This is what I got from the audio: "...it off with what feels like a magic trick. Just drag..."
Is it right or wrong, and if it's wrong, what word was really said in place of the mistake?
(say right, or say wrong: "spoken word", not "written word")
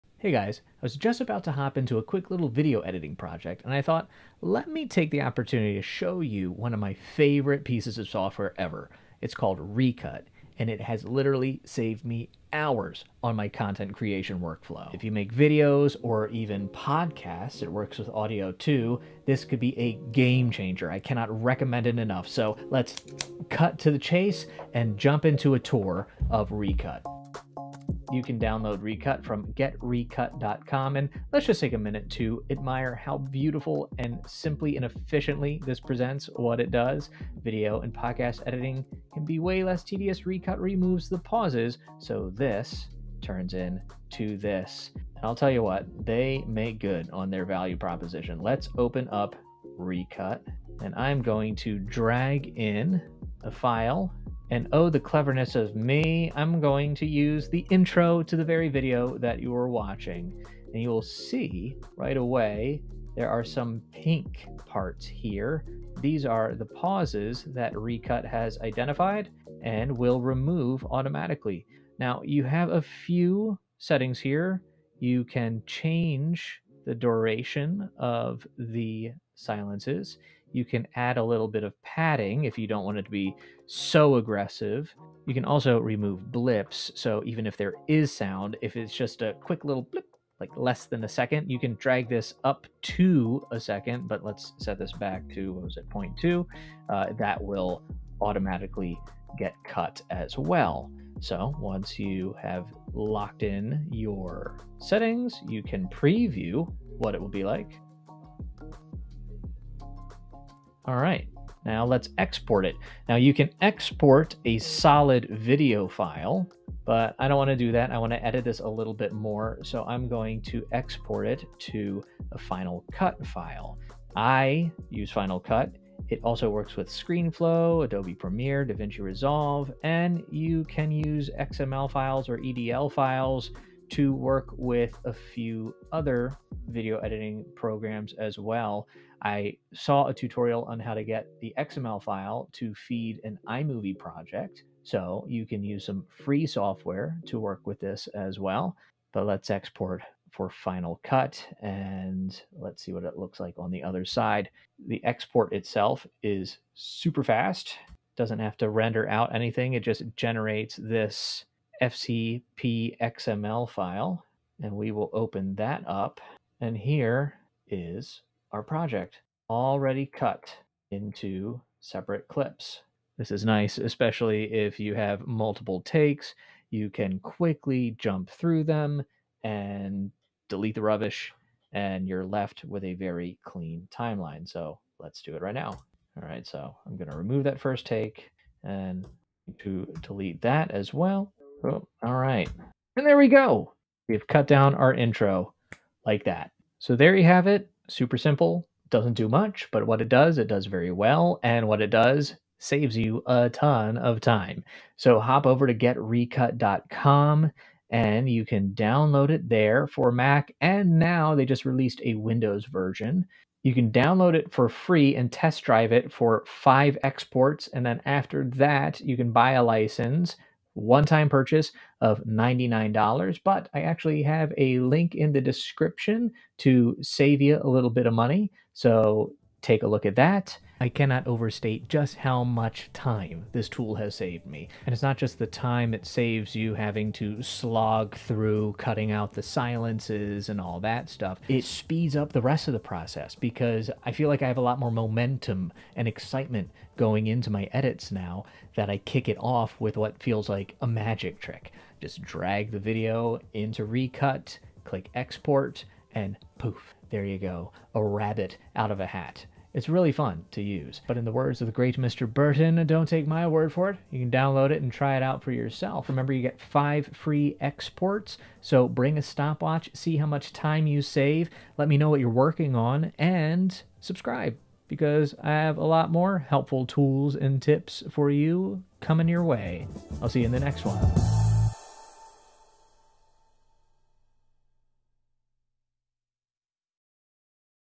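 right.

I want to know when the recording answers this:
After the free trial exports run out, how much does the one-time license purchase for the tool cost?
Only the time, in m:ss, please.
3:42.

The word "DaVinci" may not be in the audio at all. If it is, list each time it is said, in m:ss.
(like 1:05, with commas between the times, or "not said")
2:08.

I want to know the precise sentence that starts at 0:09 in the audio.
It's called Recut and it has literally saved me hours on my content creation workflow.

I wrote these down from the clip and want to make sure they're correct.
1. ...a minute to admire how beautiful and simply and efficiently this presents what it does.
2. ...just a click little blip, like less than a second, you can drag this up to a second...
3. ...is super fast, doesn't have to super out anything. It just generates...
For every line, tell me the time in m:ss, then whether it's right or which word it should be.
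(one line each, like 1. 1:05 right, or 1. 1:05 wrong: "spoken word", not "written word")
1. 0:31 right
2. 1:28 wrong: "quick", not "click"
3. 2:36 wrong: "render", not "super".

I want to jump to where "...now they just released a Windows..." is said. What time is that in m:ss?
3:30.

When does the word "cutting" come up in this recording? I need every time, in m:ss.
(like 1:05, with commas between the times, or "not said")
3:58.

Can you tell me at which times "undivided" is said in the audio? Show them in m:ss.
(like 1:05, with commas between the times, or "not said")
not said.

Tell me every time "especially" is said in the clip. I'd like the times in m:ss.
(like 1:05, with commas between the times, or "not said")
2:53.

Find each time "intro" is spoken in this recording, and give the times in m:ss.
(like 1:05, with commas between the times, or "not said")
0:57, 3:14.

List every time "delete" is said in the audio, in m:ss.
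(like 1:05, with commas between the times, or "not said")
3:00, 3:10.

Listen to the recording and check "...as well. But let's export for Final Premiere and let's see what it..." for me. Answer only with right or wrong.
wrong.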